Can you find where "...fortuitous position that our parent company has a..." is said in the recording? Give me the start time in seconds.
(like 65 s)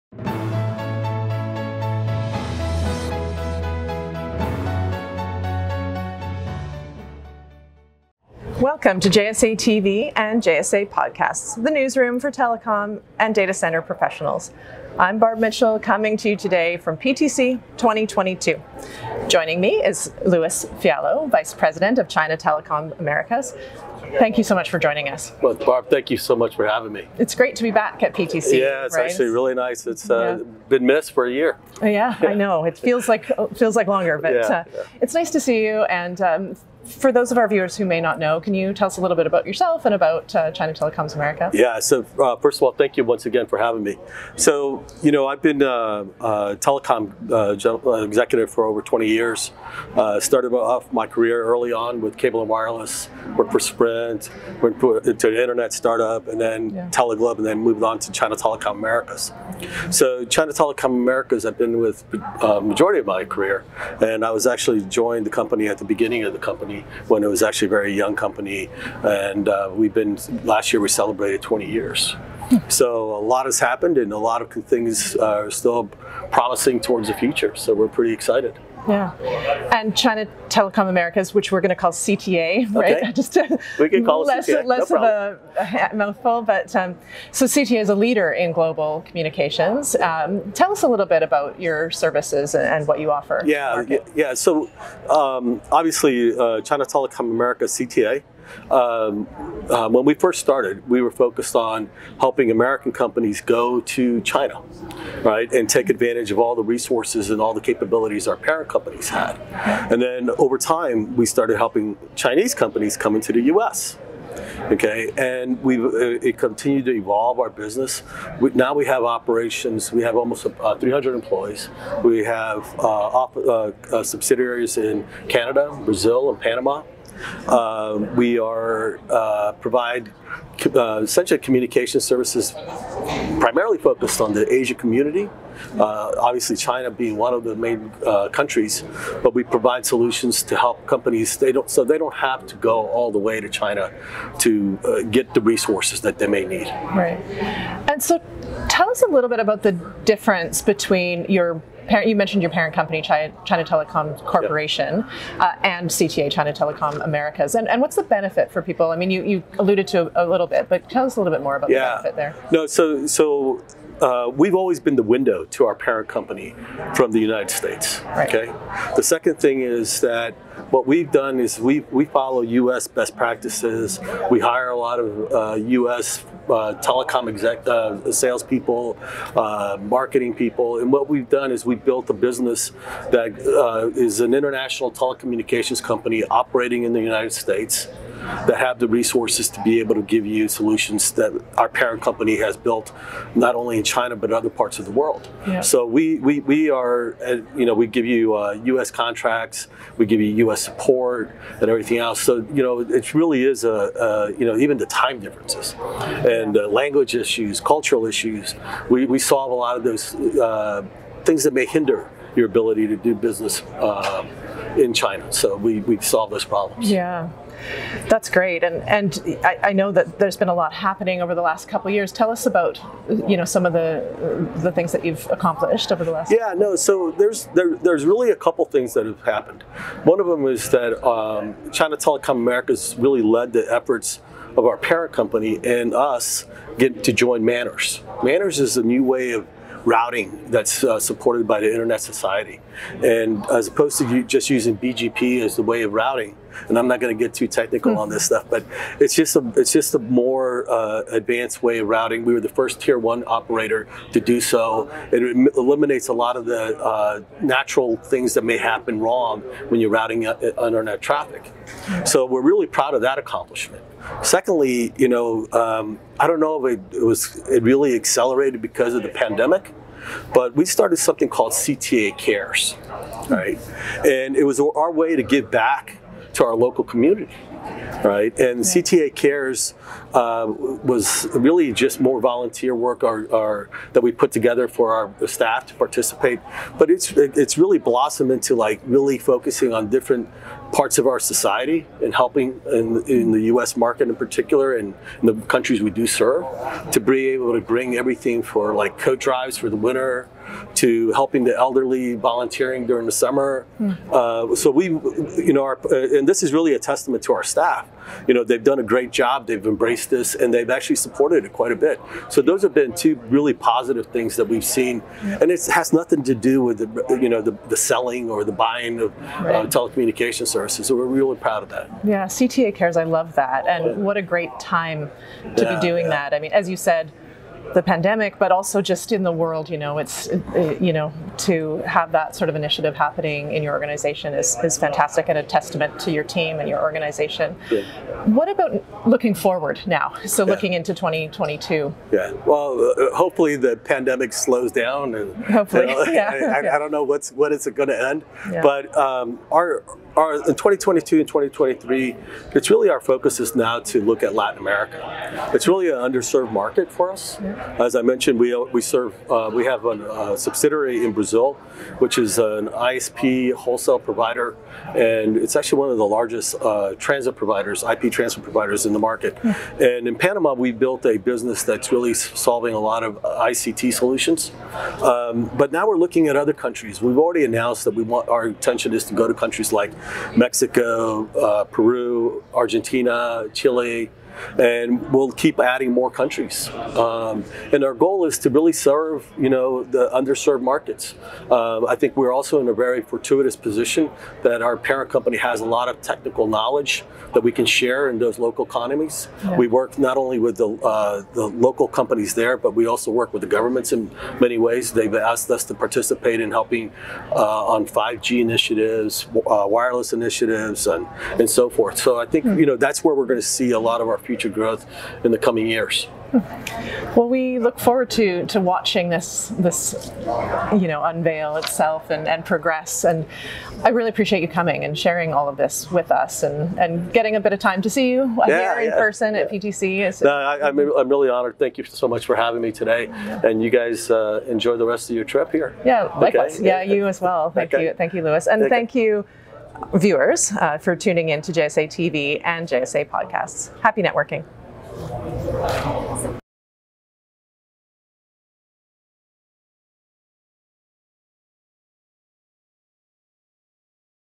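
393 s.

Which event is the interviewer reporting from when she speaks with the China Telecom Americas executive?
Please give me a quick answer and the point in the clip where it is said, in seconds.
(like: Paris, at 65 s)
PTC 2022, at 16 s.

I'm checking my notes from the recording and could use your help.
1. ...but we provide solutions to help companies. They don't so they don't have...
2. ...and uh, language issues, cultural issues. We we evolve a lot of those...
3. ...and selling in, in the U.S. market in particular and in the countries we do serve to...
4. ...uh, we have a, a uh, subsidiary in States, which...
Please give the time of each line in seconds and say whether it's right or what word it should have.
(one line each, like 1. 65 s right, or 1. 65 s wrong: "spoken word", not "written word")
1. 139 s right
2. 205 s wrong: "solve", not "evolve"
3. 292 s wrong: "helping", not "selling"
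4. 359 s wrong: "Brazil", not "States".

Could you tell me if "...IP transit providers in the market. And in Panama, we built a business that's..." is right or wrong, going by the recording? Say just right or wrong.
right.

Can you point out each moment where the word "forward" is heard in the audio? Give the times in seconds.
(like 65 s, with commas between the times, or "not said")
339 s, 417 s.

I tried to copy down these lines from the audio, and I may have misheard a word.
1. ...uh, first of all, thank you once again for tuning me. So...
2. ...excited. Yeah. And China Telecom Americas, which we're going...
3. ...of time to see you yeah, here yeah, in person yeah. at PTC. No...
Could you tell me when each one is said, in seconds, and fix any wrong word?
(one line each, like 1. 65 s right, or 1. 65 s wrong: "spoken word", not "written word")
1. 42 s wrong: "having", not "tuning"
2. 78 s right
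3. 427 s right.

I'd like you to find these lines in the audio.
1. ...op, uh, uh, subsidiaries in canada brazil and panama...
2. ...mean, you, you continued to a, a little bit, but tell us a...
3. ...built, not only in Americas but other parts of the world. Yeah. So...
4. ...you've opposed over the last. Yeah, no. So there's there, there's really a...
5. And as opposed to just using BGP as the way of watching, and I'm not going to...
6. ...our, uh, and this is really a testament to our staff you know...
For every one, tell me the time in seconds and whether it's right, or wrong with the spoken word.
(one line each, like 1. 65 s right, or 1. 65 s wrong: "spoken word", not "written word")
1. 123 s right
2. 158 s wrong: "alluded", not "continued"
3. 192 s wrong: "China", not "Americas"
4. 225 s wrong: "accomplished", not "opposed"
5. 243 s wrong: "routing", not "watching"
6. 305 s right.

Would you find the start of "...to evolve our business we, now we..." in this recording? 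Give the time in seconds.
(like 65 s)
116 s.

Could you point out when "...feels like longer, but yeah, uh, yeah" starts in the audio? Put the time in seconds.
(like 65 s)
33 s.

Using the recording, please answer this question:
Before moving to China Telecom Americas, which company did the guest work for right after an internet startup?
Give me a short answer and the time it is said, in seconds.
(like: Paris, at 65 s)
Teleglobe, at 56 s.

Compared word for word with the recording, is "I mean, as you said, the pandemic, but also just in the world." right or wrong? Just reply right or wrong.
right.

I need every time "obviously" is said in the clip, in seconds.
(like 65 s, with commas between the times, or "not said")
95 s, 136 s.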